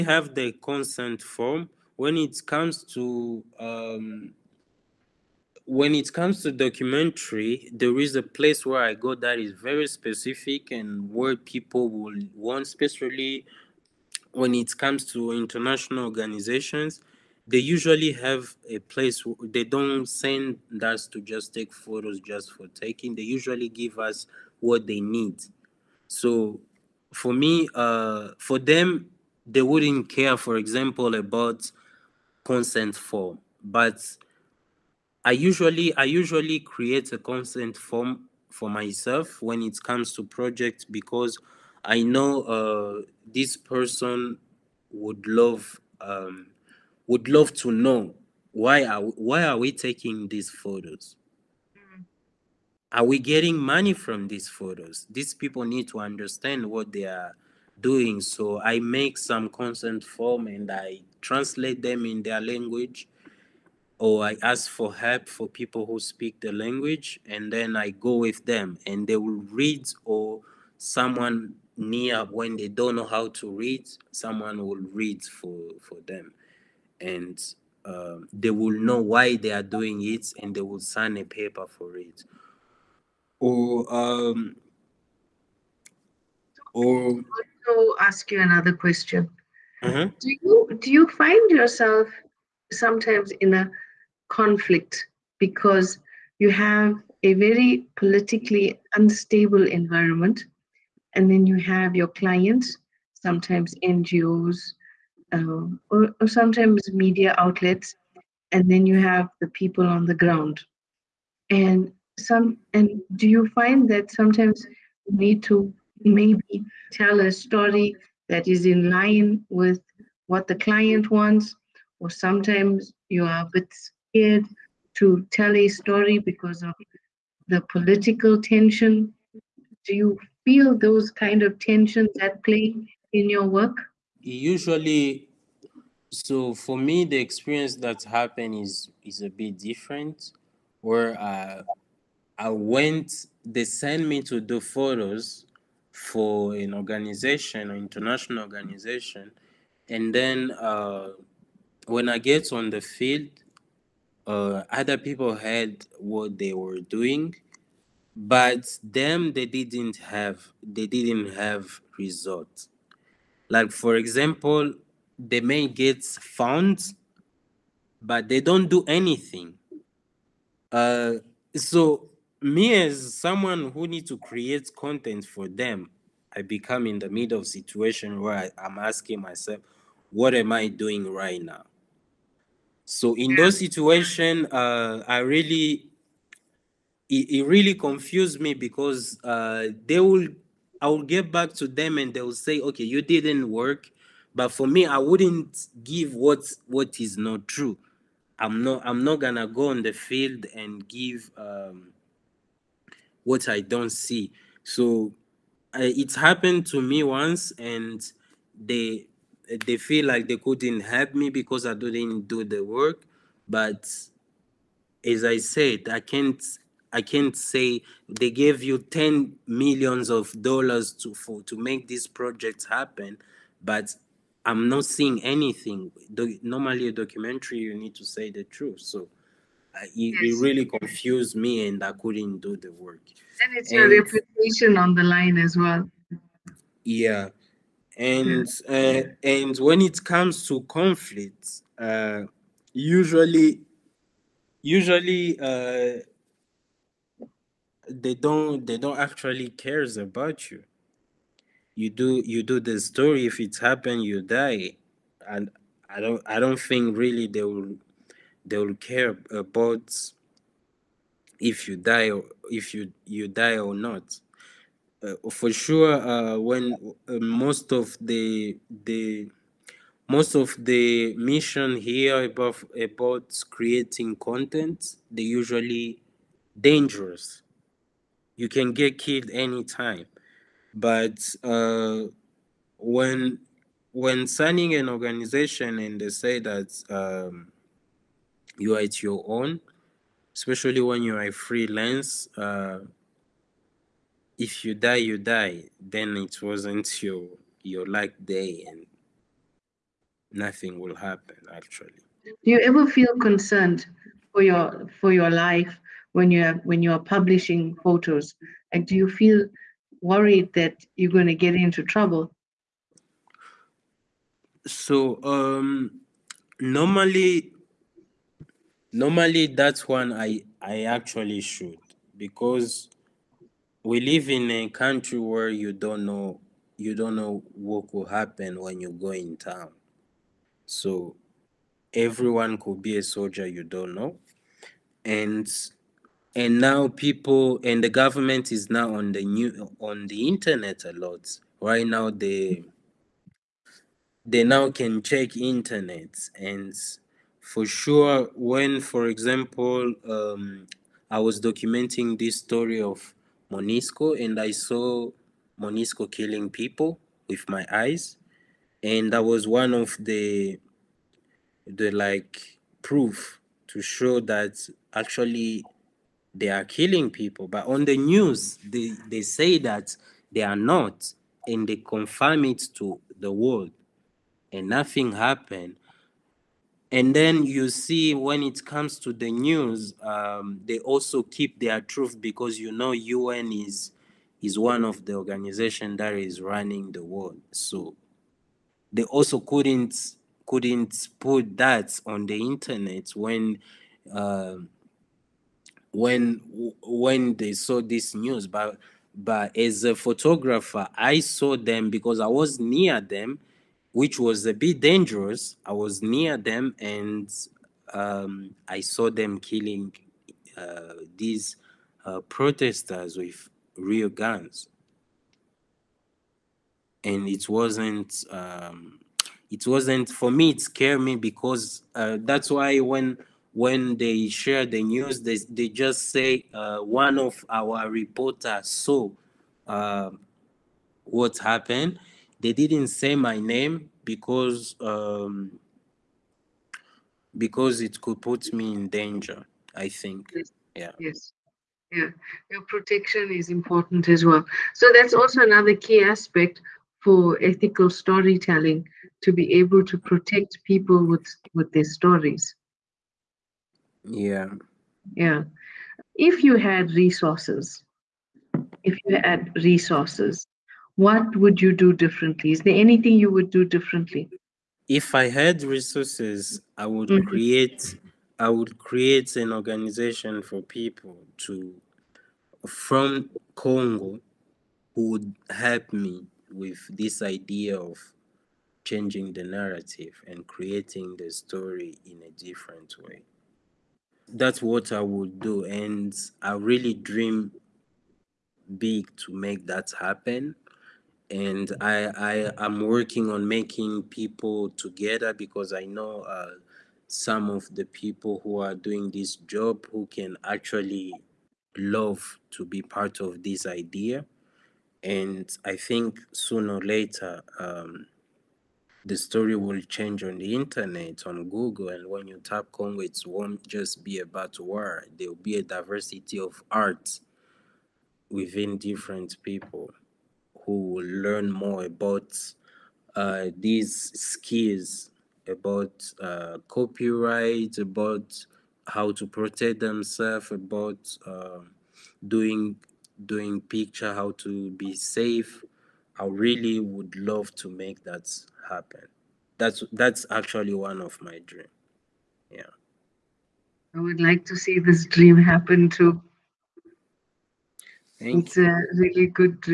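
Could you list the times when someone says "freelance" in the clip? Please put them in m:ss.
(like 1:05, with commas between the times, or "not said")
4:51.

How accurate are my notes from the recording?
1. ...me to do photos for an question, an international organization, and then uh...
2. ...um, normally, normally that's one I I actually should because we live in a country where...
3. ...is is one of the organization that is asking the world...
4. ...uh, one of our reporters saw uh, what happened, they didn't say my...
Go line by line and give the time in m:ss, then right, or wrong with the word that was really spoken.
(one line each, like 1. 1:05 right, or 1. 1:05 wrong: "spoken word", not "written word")
1. 2:24 wrong: "organization", not "question"
2. 5:15 right
3. 6:23 wrong: "running", not "asking"
4. 7:06 right.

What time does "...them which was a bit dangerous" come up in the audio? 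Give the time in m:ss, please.
6:42.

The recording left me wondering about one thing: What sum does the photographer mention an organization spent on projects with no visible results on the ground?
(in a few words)
$10 million.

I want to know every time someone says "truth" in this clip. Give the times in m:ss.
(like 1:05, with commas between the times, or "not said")
3:48, 6:21.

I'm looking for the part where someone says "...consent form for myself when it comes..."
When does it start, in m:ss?
0:37.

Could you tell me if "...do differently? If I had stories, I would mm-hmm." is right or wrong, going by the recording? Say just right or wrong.
wrong.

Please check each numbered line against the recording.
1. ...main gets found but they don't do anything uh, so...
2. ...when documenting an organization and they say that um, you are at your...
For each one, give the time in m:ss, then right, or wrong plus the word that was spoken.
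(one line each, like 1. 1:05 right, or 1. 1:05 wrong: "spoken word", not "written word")
1. 2:45 right
2. 4:43 wrong: "signing", not "documenting".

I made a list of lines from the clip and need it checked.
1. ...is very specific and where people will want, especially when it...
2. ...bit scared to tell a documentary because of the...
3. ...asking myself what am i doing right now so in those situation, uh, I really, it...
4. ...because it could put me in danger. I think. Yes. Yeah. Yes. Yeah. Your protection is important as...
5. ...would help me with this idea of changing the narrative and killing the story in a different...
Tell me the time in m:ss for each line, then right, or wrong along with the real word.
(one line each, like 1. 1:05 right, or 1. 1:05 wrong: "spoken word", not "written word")
1. 0:09 right
2. 2:03 wrong: "story", not "documentary"
3. 2:58 right
4. 7:17 right
5. 7:55 wrong: "creating", not "killing".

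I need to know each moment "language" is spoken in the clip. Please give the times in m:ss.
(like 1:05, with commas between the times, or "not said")
1:02, 1:06.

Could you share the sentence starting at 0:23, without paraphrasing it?
They usually give us what they need.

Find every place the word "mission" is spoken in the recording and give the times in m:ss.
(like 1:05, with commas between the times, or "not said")
4:31.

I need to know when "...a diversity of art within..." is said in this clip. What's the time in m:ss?
8:35.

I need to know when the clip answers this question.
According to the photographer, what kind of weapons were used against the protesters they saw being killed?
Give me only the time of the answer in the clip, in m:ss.
6:53.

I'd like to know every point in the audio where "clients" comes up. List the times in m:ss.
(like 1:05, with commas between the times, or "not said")
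1:42, 2:00.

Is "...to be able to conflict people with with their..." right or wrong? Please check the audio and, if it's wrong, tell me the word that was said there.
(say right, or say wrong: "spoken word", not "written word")
wrong: "protect", not "conflict".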